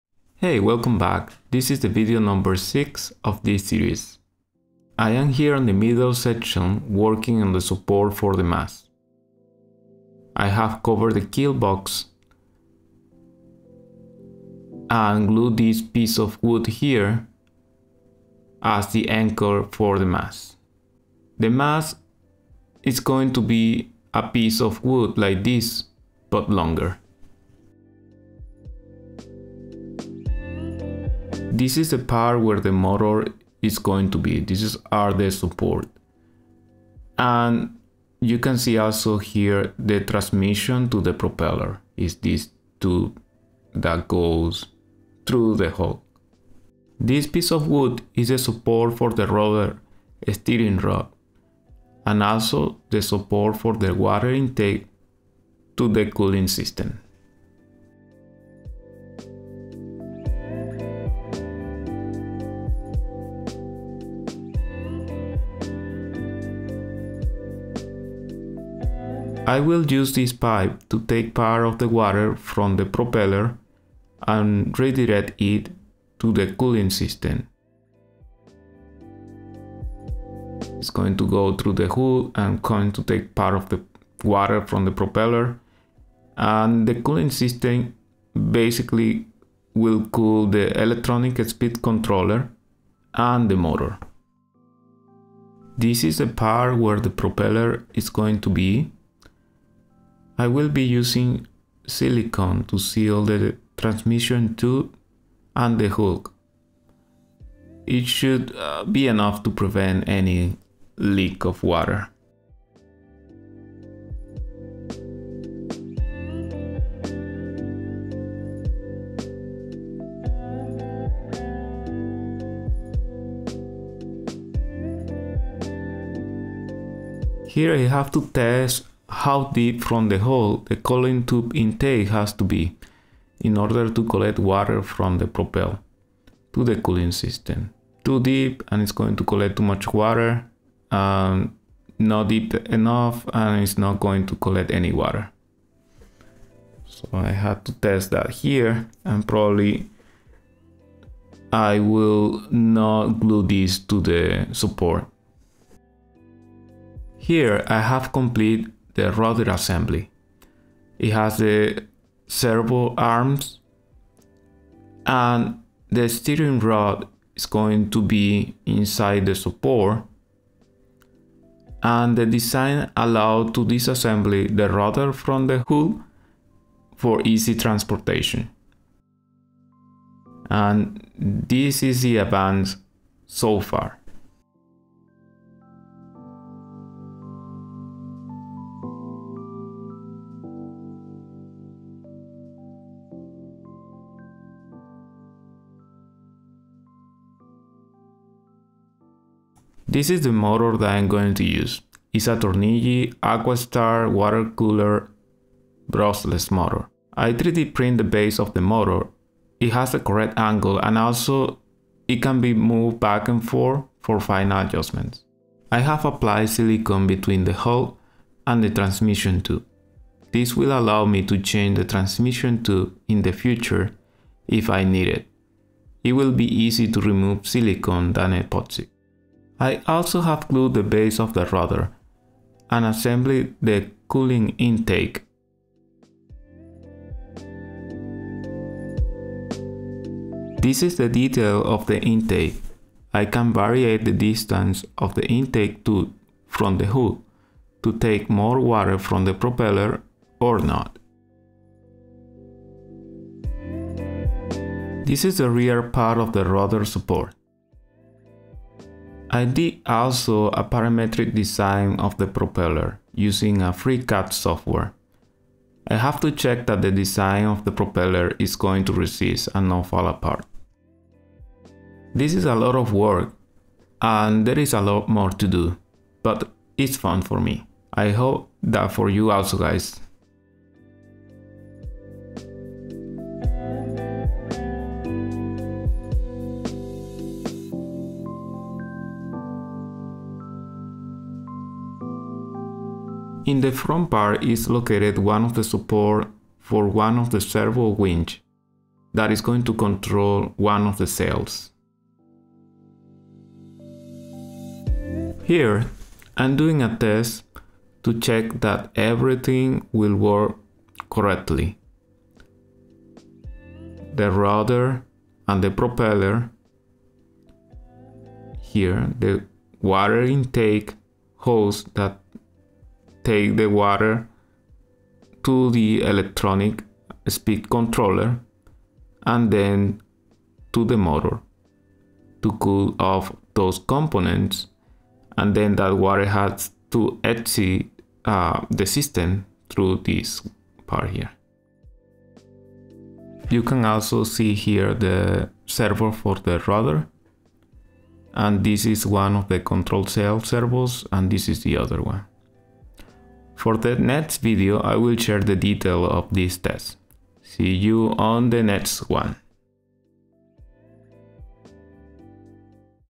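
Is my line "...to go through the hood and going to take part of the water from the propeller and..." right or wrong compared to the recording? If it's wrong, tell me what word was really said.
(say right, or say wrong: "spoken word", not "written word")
right.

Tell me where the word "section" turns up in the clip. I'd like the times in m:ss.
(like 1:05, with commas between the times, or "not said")
0:06.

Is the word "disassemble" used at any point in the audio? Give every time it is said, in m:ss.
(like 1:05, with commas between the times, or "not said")
2:53.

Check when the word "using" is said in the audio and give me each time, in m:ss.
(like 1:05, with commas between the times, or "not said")
1:40, 4:23.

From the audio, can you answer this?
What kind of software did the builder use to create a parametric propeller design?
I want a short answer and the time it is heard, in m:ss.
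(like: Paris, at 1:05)
Free CAD software, at 4:23.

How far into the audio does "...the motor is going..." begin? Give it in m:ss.
0:32.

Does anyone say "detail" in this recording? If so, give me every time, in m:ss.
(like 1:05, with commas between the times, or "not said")
4:01, 5:55.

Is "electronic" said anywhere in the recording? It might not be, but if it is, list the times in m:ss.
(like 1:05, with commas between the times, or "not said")
1:30, 5:26.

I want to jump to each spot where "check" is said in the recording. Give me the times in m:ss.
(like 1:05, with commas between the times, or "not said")
4:26, 5:08.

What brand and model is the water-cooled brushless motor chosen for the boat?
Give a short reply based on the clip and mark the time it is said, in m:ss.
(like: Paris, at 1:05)
Turnigy AquaStar, at 3:22.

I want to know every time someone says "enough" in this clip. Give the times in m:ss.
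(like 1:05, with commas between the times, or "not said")
1:49, 2:22.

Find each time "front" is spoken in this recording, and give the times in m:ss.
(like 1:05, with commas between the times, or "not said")
4:53.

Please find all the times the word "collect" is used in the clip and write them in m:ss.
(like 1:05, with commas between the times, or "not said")
2:14, 2:19, 2:24.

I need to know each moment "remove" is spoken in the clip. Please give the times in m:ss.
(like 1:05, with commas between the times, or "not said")
3:47.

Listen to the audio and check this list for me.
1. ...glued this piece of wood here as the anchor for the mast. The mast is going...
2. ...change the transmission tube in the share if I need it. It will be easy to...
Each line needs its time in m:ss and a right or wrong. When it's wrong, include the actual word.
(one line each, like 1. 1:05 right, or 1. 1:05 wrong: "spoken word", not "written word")
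1. 0:15 right
2. 3:41 wrong: "future", not "share".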